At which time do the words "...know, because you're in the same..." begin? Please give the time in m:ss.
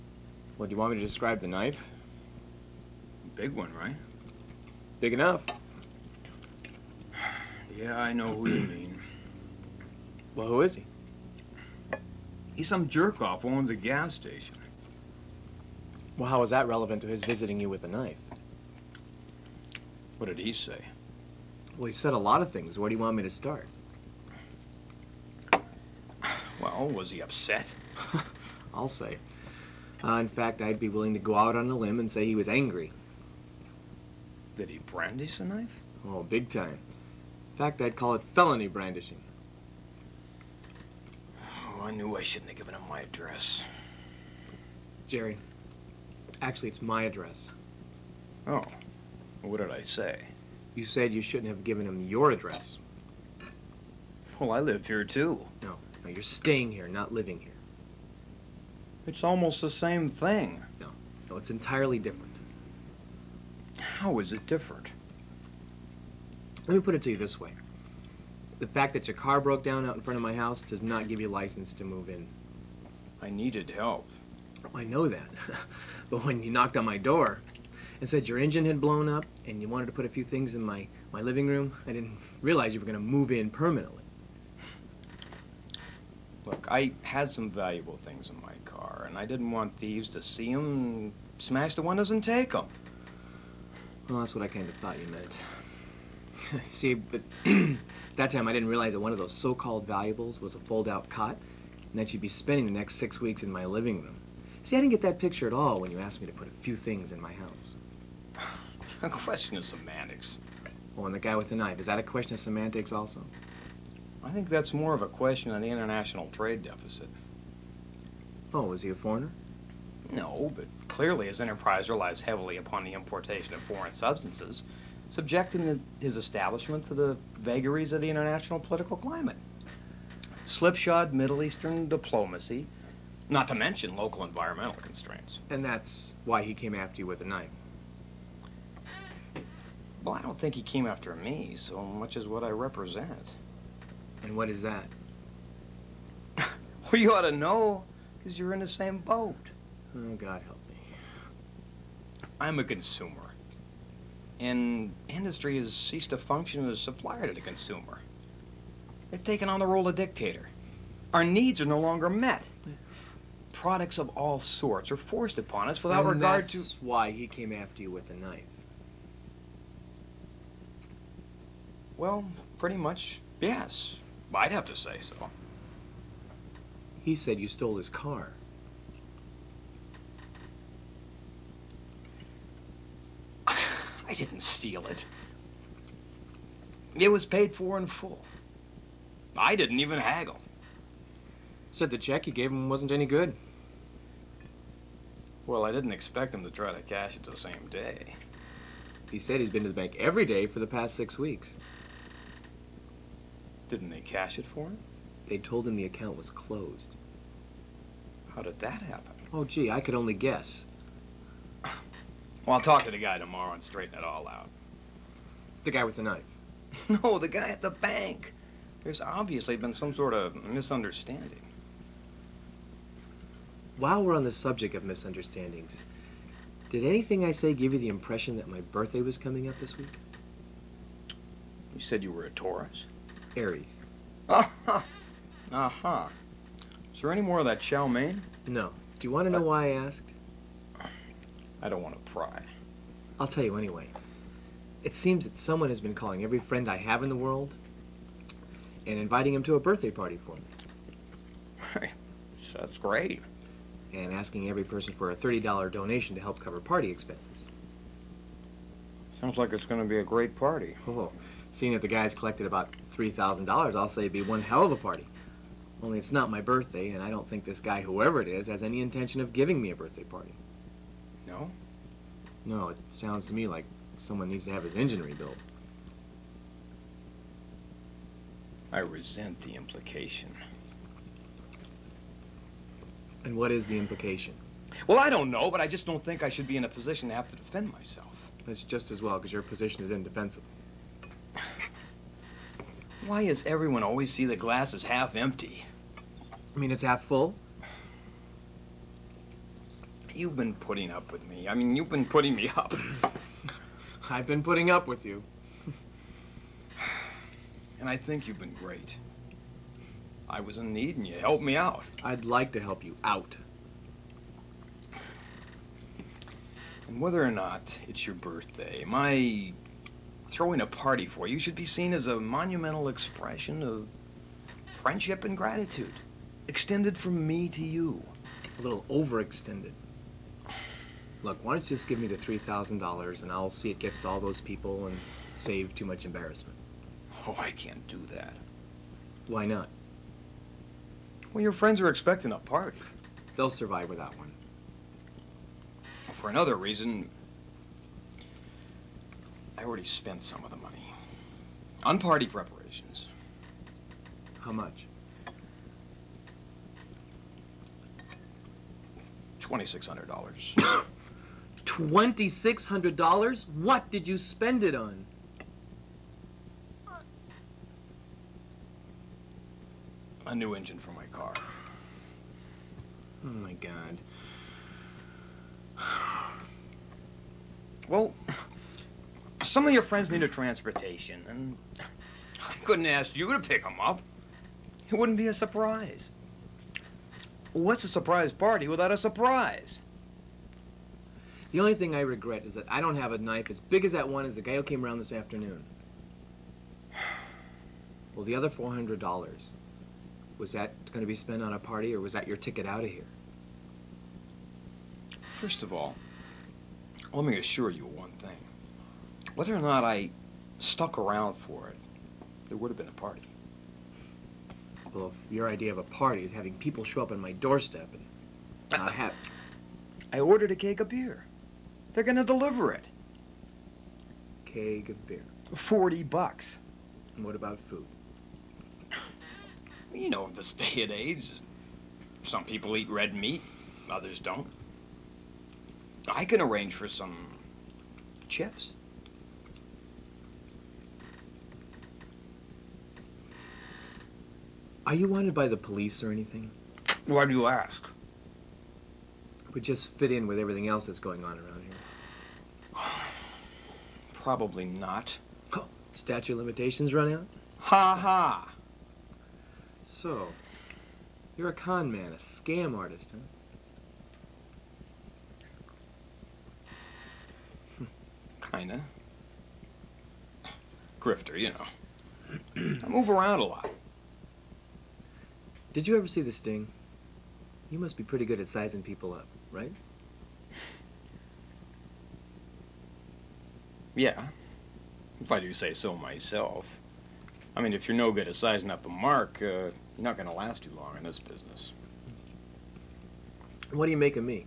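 2:27.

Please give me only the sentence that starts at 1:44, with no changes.
See, I didn't get that picture at all when you asked me to put a few things in my house.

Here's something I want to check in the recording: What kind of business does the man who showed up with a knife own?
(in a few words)
Gas station.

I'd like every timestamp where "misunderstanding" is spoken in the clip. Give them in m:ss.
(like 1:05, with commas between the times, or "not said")
3:40, 3:44.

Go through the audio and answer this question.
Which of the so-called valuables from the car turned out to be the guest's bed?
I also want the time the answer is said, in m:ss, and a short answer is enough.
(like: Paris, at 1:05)
Fold-out cot, at 1:40.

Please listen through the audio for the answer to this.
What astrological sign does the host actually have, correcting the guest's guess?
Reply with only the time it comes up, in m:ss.
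3:53.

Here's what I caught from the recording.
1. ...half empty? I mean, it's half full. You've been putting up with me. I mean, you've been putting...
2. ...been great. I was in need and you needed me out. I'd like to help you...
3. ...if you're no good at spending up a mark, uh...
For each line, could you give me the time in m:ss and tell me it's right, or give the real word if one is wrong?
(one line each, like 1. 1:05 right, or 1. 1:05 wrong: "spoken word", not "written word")
1. 4:54 right
2. 5:08 wrong: "helped", not "needed"
3. 8:07 wrong: "sizing", not "spending".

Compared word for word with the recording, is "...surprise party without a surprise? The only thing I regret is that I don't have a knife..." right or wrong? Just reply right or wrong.
right.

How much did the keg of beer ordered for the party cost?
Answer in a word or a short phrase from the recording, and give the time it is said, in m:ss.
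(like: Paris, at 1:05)
$40, at 7:05.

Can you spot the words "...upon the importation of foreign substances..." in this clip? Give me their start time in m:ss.
2:02.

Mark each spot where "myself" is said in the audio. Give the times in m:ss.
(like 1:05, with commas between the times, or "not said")
4:47, 8:05.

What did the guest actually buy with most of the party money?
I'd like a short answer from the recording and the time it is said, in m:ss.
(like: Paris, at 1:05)
A new engine, at 6:10.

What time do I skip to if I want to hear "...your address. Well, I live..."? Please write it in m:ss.
0:52.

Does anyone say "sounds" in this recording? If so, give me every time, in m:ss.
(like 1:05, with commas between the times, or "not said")
4:19, 4:32.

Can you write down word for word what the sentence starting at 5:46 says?
For another reason, I already spent some of the money on party preparations.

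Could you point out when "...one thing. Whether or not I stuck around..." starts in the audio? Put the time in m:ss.
6:47.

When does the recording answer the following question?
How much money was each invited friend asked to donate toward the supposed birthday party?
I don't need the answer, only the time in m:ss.
4:15.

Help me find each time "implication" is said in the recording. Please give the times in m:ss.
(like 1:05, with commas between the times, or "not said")
4:39, 4:43.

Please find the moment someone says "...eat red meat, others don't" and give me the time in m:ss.
7:12.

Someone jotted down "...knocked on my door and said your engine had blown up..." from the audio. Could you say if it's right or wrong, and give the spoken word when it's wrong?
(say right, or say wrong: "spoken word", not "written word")
right.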